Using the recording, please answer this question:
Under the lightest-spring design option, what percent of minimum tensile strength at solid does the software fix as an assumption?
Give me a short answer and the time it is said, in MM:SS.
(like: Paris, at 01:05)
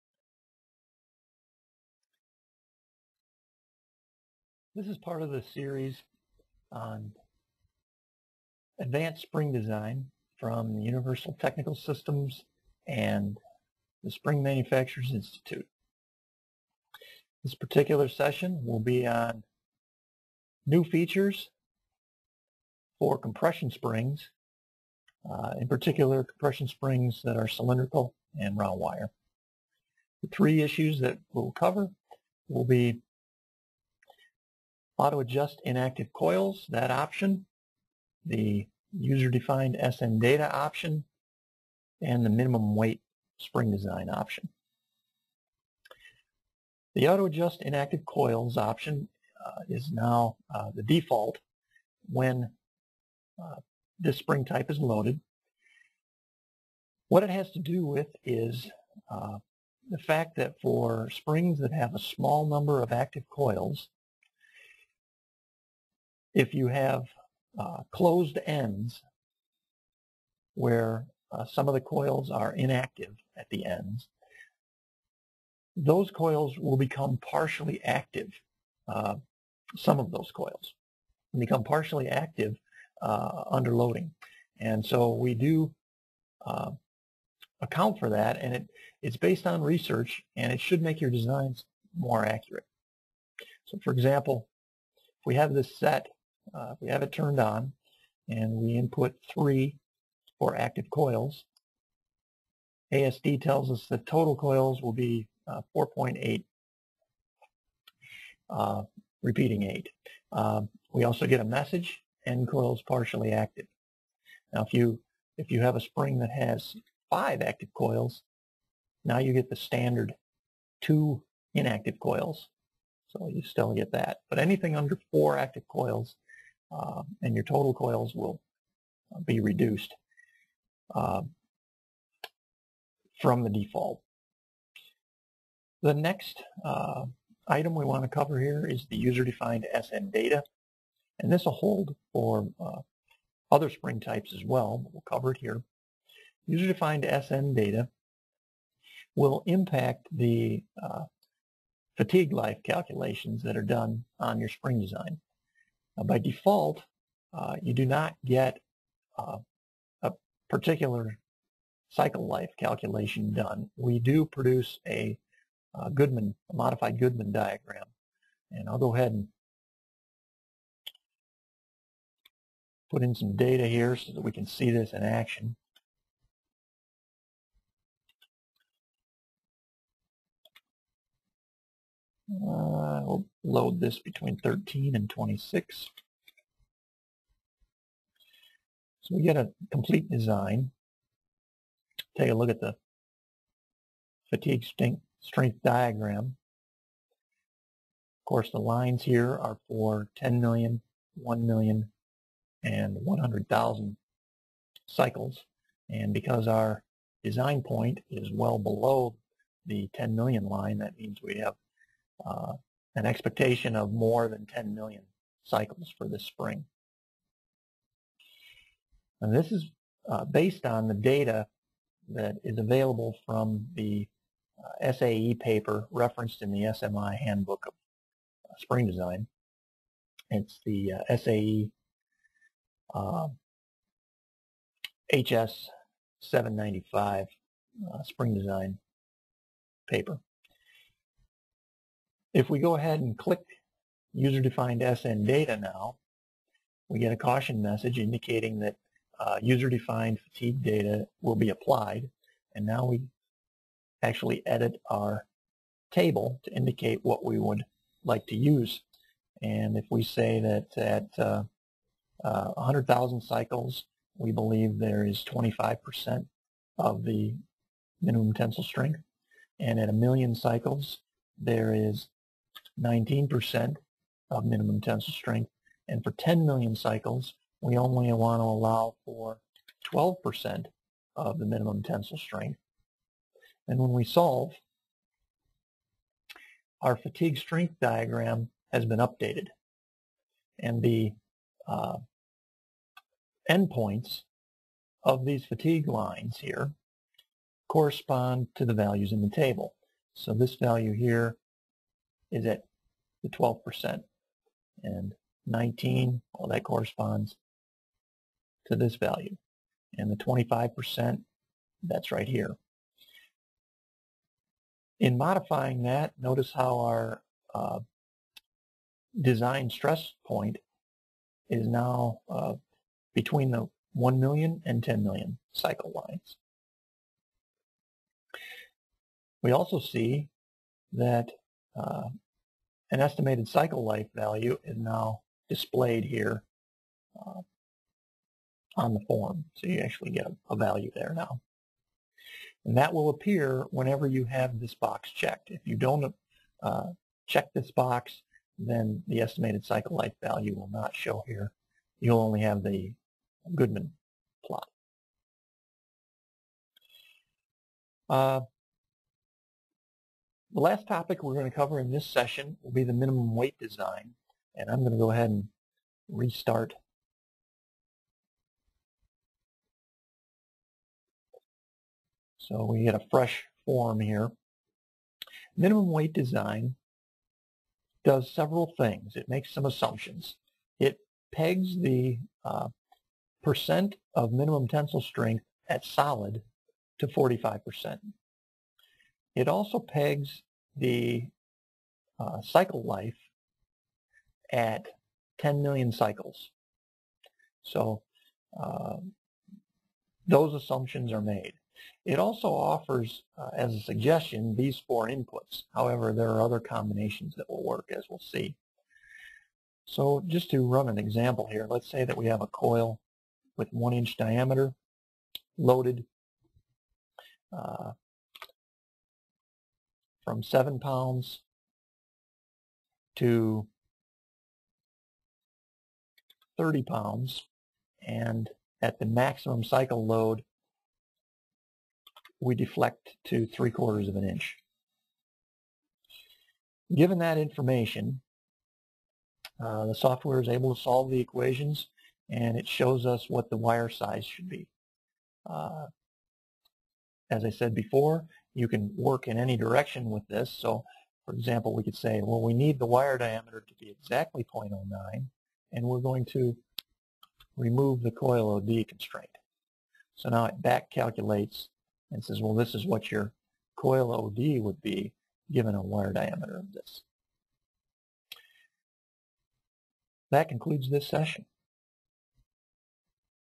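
45 percent, at 06:27.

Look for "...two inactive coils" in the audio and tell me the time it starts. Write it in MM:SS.
02:00.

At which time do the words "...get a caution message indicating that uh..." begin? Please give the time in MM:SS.
04:06.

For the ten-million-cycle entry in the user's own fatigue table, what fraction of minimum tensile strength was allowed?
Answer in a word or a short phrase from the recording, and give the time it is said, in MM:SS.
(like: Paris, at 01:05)
12%, at 04:39.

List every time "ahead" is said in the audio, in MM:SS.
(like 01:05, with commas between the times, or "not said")
02:48, 04:02, 06:05.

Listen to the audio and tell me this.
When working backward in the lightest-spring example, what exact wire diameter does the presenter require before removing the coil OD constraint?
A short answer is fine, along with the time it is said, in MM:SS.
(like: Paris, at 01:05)
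0.09, at 07:34.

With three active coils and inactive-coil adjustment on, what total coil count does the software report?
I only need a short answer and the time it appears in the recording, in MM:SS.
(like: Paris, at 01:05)
4.88, at 01:45.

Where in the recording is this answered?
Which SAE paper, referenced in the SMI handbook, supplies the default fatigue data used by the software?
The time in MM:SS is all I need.
03:51.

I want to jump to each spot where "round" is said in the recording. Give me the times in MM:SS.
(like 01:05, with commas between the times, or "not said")
00:28.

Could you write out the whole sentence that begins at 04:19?
And if we say that at uh, uh, 100,000 cycles, we believe there is 25% of the minimum tensile strength.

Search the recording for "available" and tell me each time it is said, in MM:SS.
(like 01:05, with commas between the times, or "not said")
03:42.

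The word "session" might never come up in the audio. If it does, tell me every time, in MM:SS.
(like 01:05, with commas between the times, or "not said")
00:18, 06:02, 07:51.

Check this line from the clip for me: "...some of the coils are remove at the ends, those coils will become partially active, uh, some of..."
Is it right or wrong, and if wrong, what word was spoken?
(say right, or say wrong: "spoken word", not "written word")
wrong: "inactive", not "remove".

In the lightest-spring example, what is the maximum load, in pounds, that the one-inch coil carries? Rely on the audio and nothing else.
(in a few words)
30 pounds.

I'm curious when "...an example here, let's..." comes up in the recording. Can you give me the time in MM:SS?
06:50.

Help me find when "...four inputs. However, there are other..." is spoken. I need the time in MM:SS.
06:44.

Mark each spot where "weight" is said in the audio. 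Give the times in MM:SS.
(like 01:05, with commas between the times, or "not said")
00:42, 06:03, 06:15.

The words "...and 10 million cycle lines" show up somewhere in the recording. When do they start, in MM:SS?
05:24.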